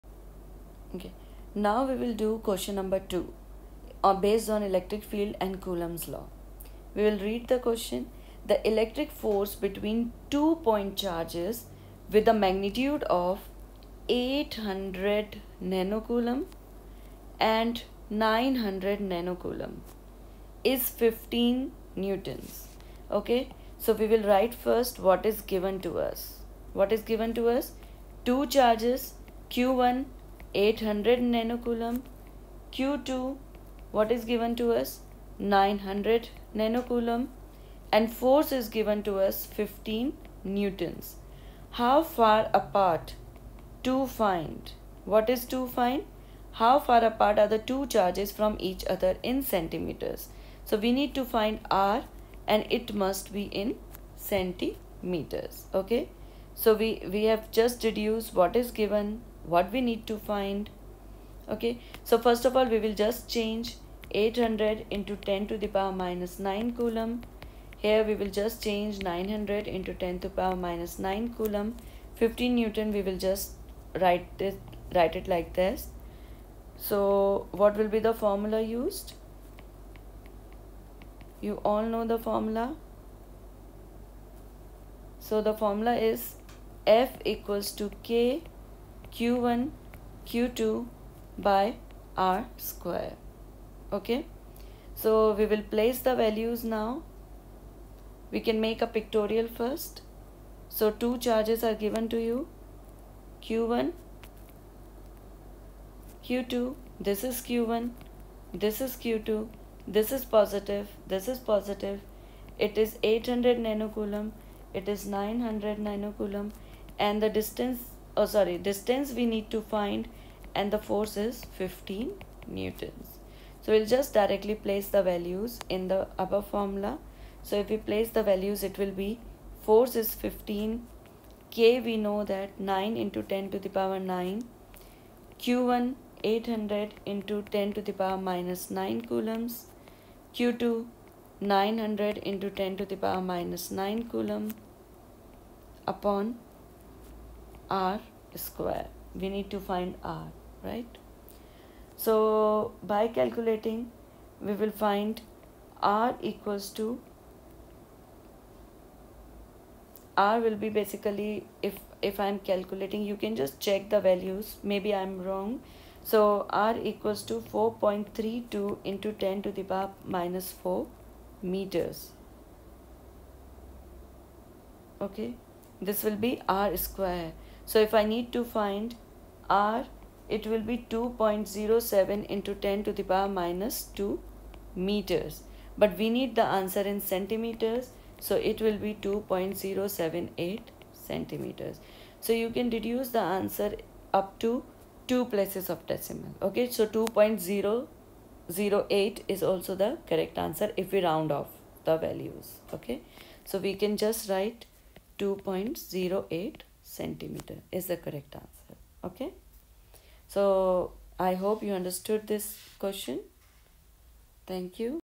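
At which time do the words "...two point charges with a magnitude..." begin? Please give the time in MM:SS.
00:10.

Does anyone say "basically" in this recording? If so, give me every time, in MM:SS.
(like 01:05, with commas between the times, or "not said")
02:40.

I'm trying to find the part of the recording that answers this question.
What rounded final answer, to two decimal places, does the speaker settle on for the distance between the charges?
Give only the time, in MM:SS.
03:25.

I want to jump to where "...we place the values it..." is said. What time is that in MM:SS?
02:07.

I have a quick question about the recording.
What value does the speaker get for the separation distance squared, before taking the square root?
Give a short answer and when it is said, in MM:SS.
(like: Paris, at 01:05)
4.32 × 10^-4 meters, at 02:47.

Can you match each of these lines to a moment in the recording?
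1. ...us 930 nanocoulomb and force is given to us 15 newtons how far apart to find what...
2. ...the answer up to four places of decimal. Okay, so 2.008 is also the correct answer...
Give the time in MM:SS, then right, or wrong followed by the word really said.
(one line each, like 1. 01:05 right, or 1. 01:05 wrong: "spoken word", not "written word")
1. 00:34 wrong: "900", not "930"
2. 03:13 wrong: "two", not "four".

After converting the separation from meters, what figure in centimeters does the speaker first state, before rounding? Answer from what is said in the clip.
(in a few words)
2.078 centimeters.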